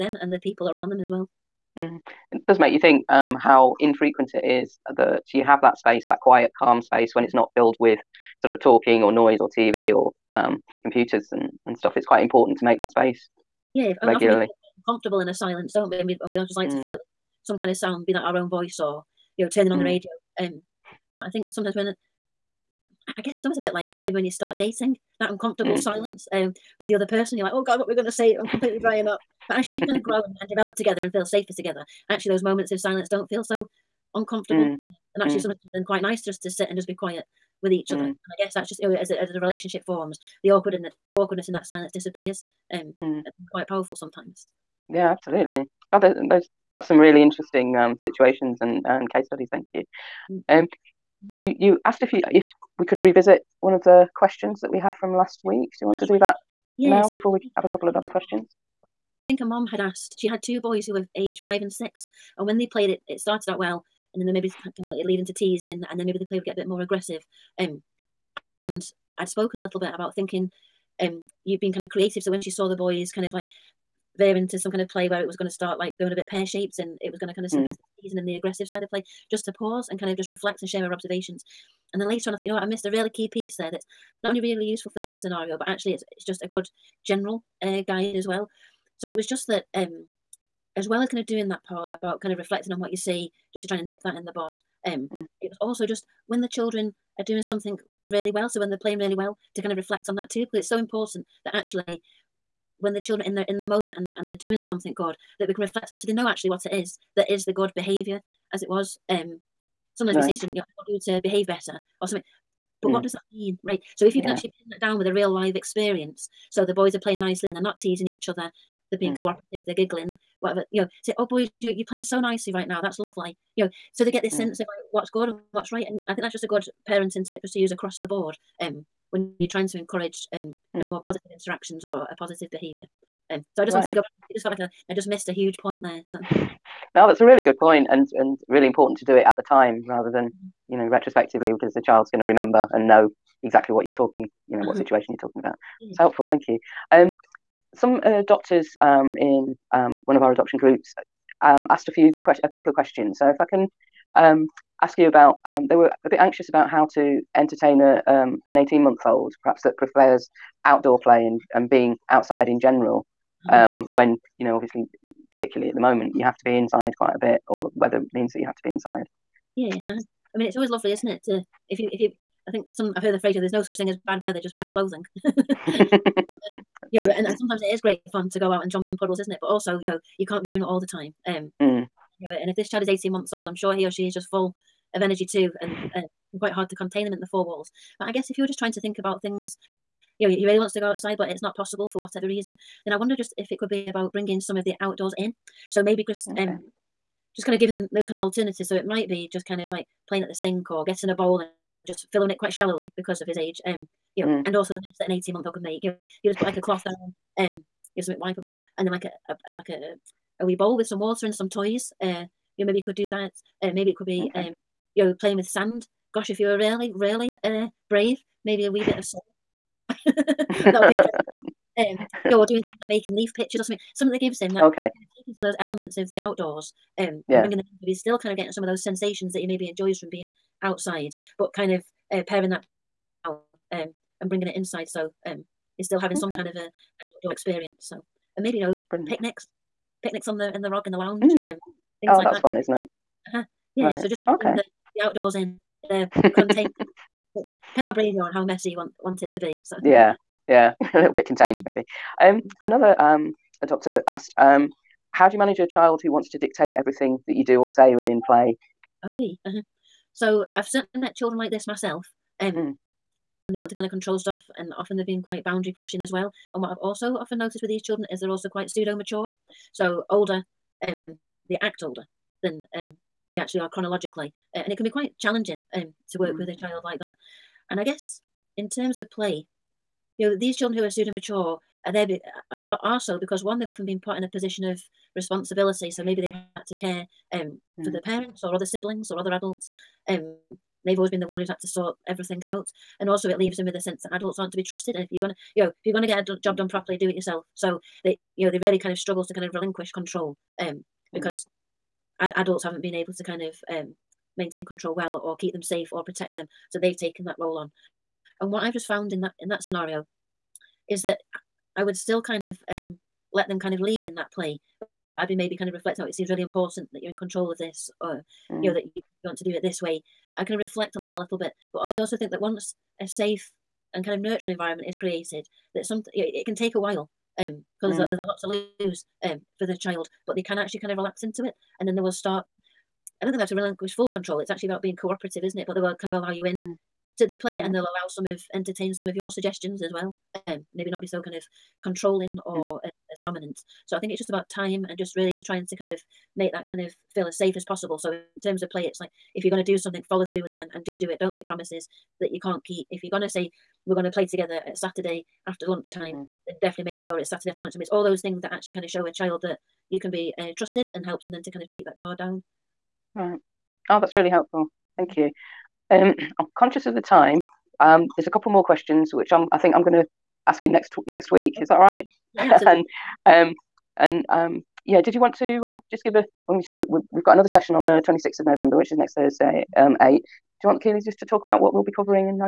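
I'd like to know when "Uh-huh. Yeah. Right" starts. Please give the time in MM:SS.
04:03.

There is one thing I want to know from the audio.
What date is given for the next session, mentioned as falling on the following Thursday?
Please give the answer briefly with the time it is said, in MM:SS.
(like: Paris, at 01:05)
26 November, at 06:18.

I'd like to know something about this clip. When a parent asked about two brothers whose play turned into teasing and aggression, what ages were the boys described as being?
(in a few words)
5 and 6.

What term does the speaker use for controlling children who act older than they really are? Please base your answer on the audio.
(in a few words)
Pseudo mature.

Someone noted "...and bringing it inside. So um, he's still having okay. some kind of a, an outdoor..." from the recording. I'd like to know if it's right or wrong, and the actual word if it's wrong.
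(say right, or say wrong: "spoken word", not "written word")
right.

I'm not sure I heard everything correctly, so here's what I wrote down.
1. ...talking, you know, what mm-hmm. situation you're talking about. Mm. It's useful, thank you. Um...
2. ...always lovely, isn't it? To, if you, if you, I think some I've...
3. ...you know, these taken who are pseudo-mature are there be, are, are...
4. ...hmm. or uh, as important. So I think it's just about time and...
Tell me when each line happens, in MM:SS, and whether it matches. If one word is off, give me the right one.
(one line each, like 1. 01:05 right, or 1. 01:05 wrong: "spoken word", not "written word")
1. 02:23 wrong: "helpful", not "useful"
2. 02:50 right
3. 04:40 wrong: "children", not "taken"
4. 05:42 wrong: "dominant", not "important".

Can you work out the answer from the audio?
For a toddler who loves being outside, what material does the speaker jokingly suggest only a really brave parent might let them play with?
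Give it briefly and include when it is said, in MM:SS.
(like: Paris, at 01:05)
Salt, at 03:39.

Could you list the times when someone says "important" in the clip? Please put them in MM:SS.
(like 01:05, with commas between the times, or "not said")
00:12, 01:40, 02:18, 05:16.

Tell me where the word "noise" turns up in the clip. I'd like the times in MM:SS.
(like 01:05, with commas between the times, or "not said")
00:09.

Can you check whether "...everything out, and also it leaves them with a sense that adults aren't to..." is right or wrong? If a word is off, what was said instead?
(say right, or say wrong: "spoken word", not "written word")
right.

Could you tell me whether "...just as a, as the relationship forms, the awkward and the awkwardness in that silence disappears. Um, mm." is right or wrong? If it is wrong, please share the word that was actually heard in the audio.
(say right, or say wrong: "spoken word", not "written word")
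right.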